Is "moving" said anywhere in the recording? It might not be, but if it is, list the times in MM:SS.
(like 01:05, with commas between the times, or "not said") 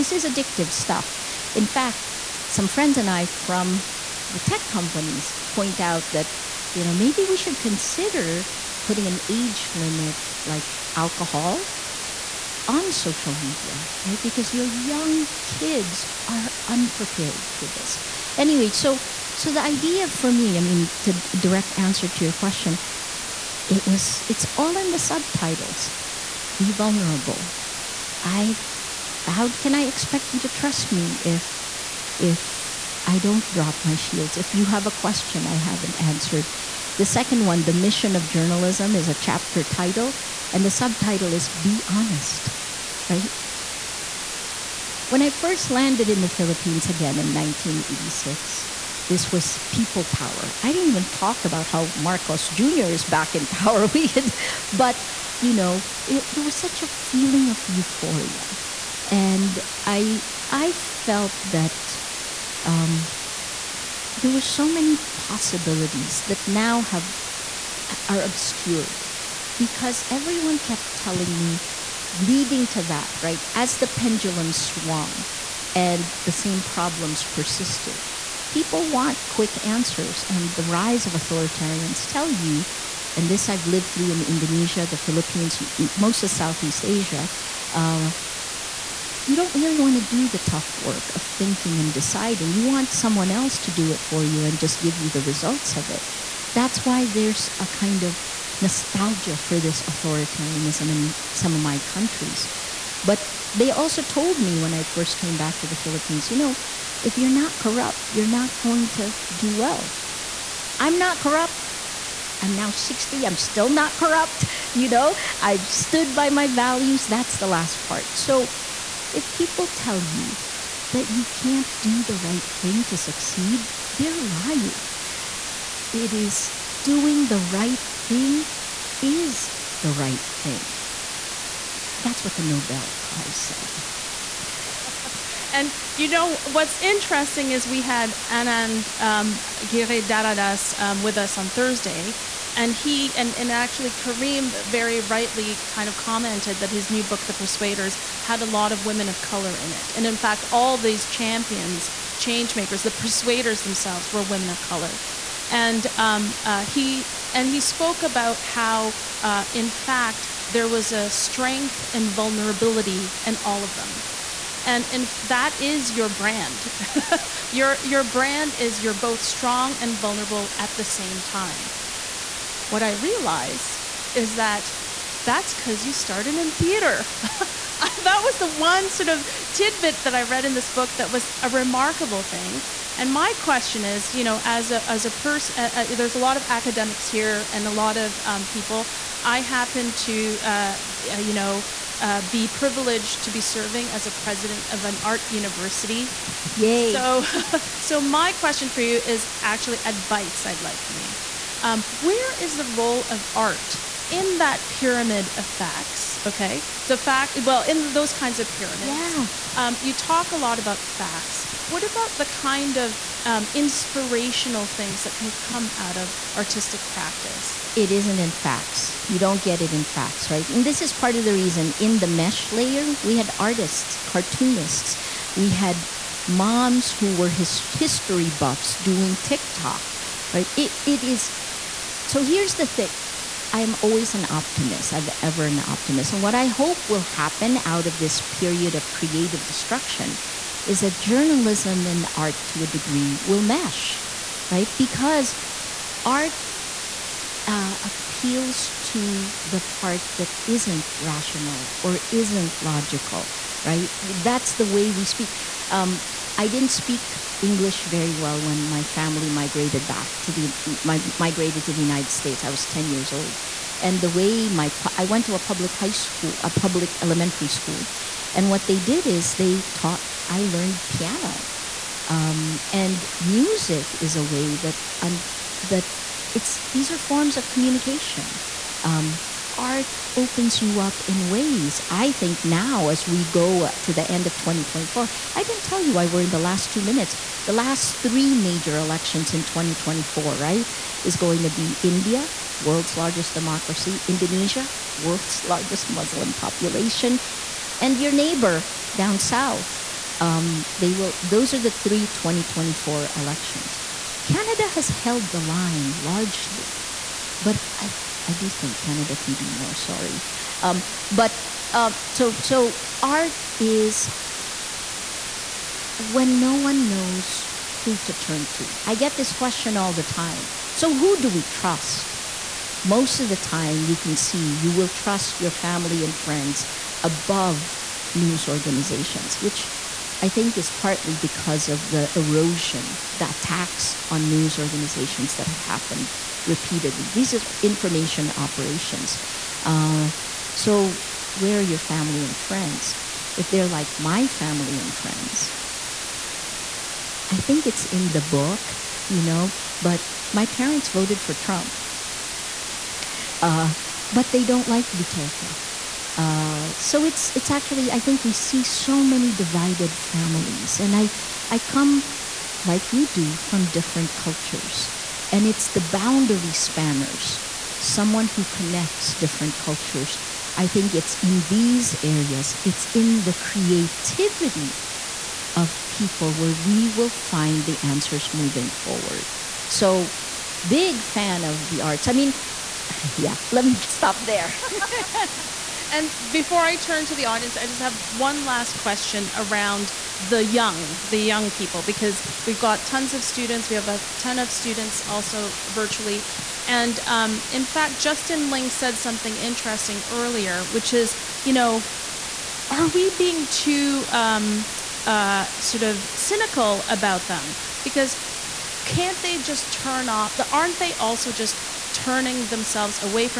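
06:18.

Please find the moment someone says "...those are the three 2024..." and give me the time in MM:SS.
05:01.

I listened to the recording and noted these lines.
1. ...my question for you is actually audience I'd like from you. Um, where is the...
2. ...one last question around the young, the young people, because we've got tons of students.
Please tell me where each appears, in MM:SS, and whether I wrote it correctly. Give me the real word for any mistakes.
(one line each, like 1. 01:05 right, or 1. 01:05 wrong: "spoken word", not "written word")
1. 03:18 wrong: "advice", not "audience"
2. 06:28 right.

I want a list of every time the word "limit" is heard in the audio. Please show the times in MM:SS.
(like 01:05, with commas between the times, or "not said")
00:09.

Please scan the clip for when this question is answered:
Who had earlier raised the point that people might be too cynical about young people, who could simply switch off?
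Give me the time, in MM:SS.
06:38.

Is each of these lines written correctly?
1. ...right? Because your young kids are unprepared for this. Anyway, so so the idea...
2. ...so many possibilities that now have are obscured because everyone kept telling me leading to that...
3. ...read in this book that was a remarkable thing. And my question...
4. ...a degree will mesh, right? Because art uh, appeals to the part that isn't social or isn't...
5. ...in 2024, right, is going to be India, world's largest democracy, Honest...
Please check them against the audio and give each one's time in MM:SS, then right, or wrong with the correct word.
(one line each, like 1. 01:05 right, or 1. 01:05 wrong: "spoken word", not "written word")
1. 00:14 right
2. 01:04 right
3. 03:00 right
4. 04:02 wrong: "rational", not "social"
5. 04:49 wrong: "Indonesia", not "Honest".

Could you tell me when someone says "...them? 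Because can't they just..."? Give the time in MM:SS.
06:47.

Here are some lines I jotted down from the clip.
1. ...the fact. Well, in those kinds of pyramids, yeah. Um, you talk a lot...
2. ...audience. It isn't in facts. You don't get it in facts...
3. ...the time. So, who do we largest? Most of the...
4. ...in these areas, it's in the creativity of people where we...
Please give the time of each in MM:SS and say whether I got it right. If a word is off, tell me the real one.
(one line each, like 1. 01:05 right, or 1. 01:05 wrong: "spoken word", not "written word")
1. 03:26 right
2. 03:36 wrong: "practice", not "audience"
3. 05:19 wrong: "trust", not "largest"
4. 06:11 right.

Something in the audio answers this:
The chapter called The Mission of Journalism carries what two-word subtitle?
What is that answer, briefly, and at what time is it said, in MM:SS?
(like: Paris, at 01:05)
Be Honest, at 00:41.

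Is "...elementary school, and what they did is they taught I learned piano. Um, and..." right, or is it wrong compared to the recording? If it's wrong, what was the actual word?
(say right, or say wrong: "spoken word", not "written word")
right.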